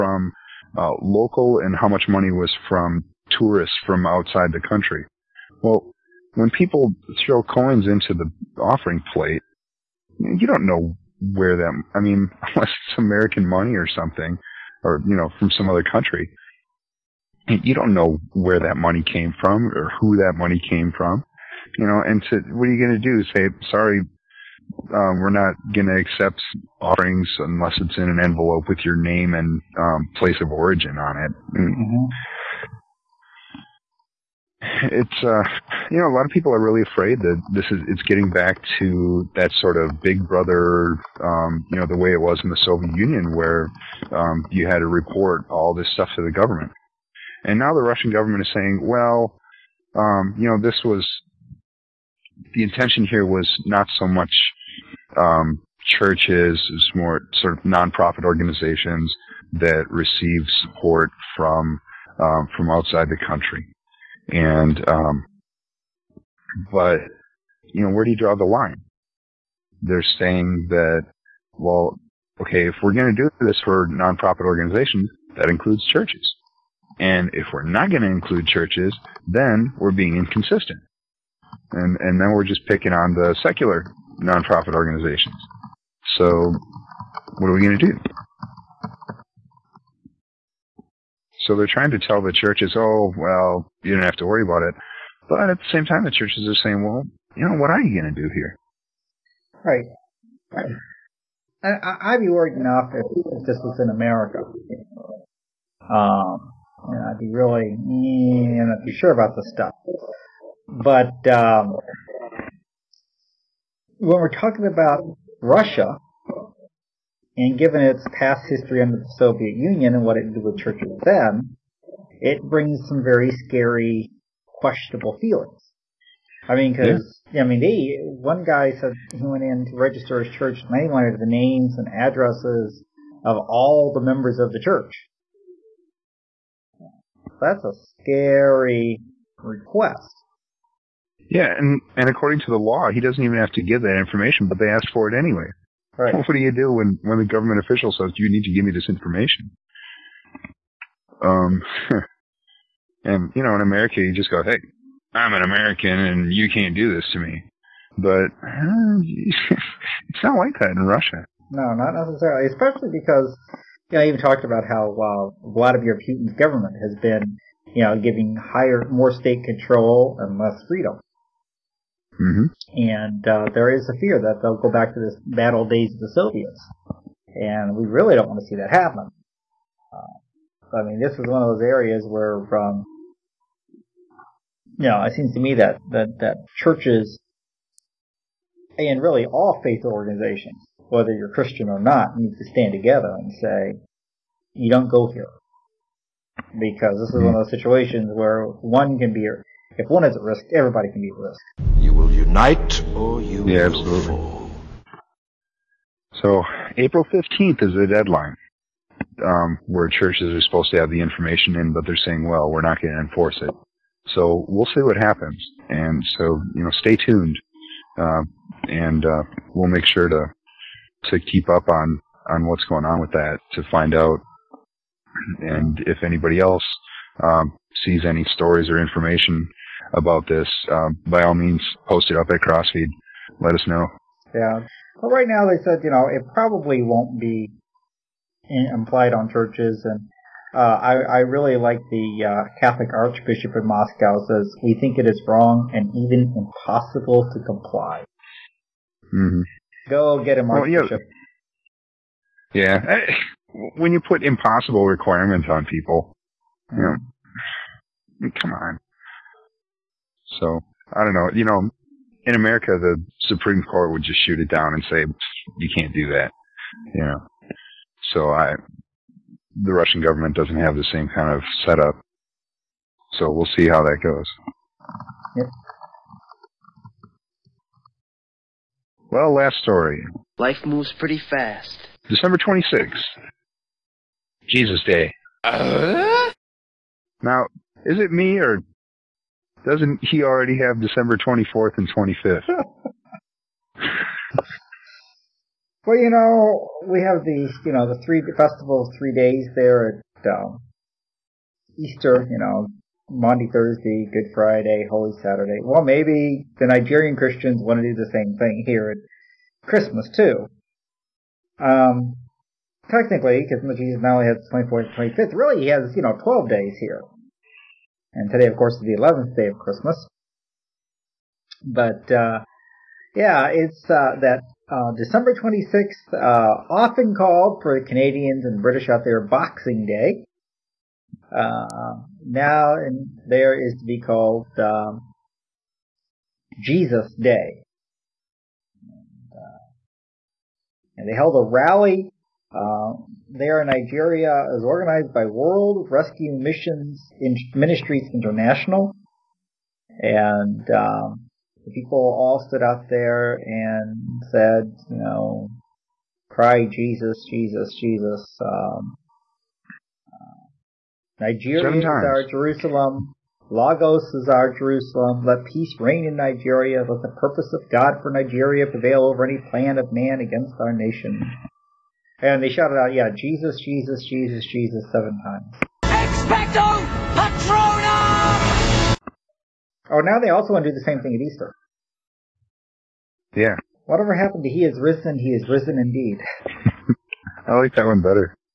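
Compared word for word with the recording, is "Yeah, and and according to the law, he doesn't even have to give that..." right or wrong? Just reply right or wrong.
right.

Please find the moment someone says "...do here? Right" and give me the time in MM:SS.
01:38.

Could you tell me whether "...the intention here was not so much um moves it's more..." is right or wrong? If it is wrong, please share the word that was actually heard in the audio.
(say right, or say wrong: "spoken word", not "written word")
wrong: "churches", not "moves".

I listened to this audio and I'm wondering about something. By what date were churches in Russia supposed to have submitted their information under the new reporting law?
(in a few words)
April 15th.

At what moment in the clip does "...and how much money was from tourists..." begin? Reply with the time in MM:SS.
00:01.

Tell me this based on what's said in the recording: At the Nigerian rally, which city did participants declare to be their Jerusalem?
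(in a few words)
Lagos.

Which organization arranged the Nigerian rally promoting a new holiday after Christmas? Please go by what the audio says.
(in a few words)
World Rescue Missions Ministries International.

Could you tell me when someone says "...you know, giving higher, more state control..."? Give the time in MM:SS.
02:47.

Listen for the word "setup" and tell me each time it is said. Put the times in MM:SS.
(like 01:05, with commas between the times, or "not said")
04:31.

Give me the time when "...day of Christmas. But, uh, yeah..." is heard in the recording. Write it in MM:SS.
05:19.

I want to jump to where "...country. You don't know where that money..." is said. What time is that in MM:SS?
00:15.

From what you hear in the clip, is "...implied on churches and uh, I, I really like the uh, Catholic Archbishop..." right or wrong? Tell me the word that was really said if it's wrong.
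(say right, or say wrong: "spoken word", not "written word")
right.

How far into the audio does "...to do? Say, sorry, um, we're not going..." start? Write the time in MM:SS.
00:23.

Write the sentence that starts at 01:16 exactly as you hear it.
And if we're not going to include churches, then we're being inconsistent.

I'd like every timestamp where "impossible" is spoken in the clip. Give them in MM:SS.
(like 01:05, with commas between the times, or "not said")
04:06, 04:14.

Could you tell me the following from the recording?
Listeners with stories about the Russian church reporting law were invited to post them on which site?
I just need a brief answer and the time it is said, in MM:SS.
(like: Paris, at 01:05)
CrossFeed, at 03:52.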